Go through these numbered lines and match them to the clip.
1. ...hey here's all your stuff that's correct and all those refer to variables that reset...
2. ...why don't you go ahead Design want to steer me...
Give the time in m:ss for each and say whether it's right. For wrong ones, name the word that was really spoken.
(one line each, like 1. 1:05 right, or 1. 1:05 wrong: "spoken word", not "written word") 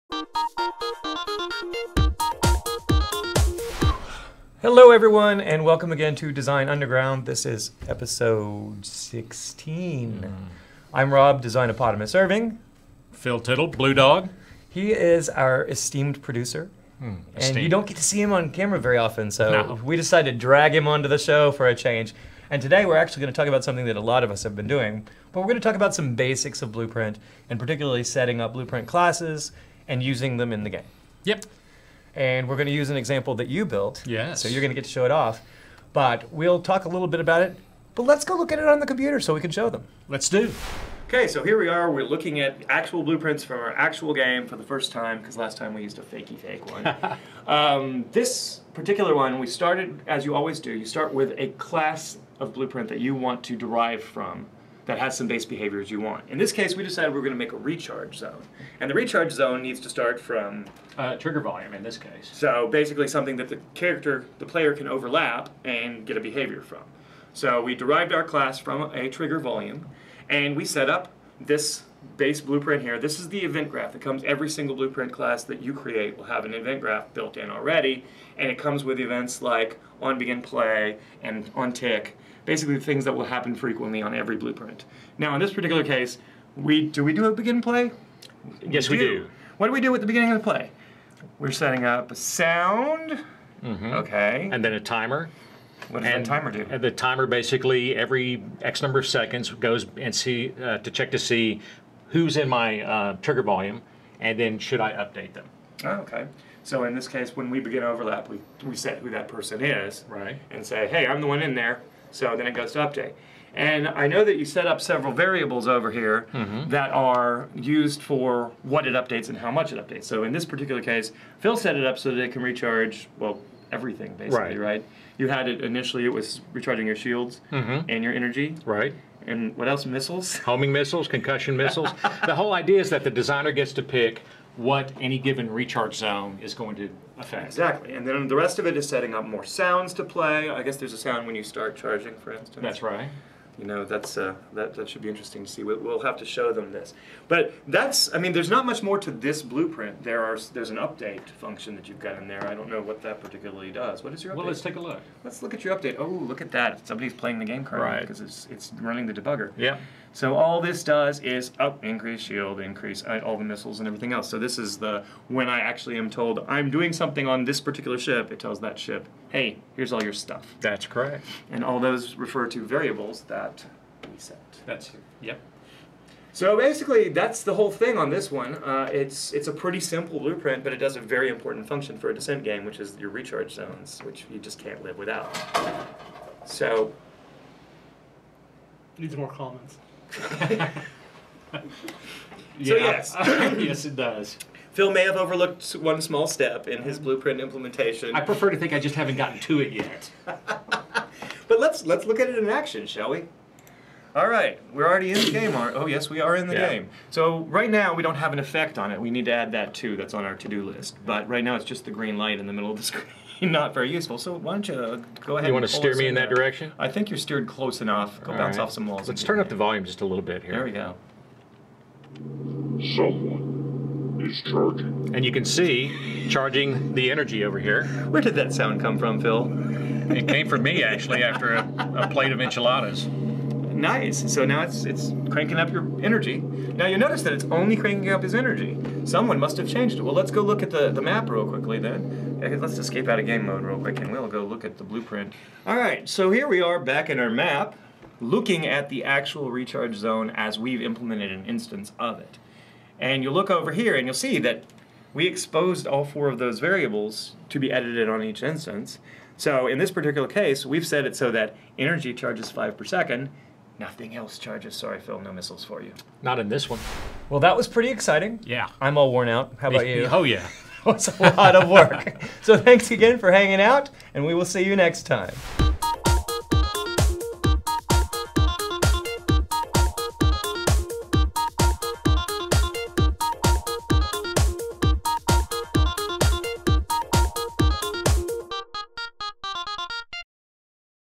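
1. 2:49 right
2. 3:34 wrong: "You", not "Design".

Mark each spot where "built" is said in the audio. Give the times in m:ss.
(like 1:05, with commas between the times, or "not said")
0:33, 1:17.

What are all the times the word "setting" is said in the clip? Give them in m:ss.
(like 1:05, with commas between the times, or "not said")
0:28, 1:31, 2:18.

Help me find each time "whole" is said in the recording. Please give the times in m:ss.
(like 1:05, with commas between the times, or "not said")
2:12, 2:57.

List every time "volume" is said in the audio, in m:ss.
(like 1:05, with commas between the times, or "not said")
1:01, 1:09, 1:43, 3:39.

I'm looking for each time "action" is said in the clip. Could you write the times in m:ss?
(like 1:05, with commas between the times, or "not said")
3:22.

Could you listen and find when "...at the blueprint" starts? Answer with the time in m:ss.
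4:04.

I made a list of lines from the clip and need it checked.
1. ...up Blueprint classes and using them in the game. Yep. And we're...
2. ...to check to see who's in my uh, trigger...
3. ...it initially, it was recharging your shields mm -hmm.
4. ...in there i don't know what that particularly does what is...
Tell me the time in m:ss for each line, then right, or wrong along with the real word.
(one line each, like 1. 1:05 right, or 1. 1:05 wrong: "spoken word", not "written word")
1. 0:28 right
2. 1:40 right
3. 2:05 right
4. 2:32 right.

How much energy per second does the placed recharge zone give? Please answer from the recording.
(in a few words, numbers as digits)
5.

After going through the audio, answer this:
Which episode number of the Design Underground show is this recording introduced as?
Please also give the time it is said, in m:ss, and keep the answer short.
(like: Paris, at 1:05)
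16, at 0:07.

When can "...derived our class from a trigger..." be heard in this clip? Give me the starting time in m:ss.
1:07.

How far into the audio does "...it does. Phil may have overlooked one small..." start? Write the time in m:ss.
3:13.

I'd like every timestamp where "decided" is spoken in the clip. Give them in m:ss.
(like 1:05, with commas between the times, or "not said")
0:19, 0:56.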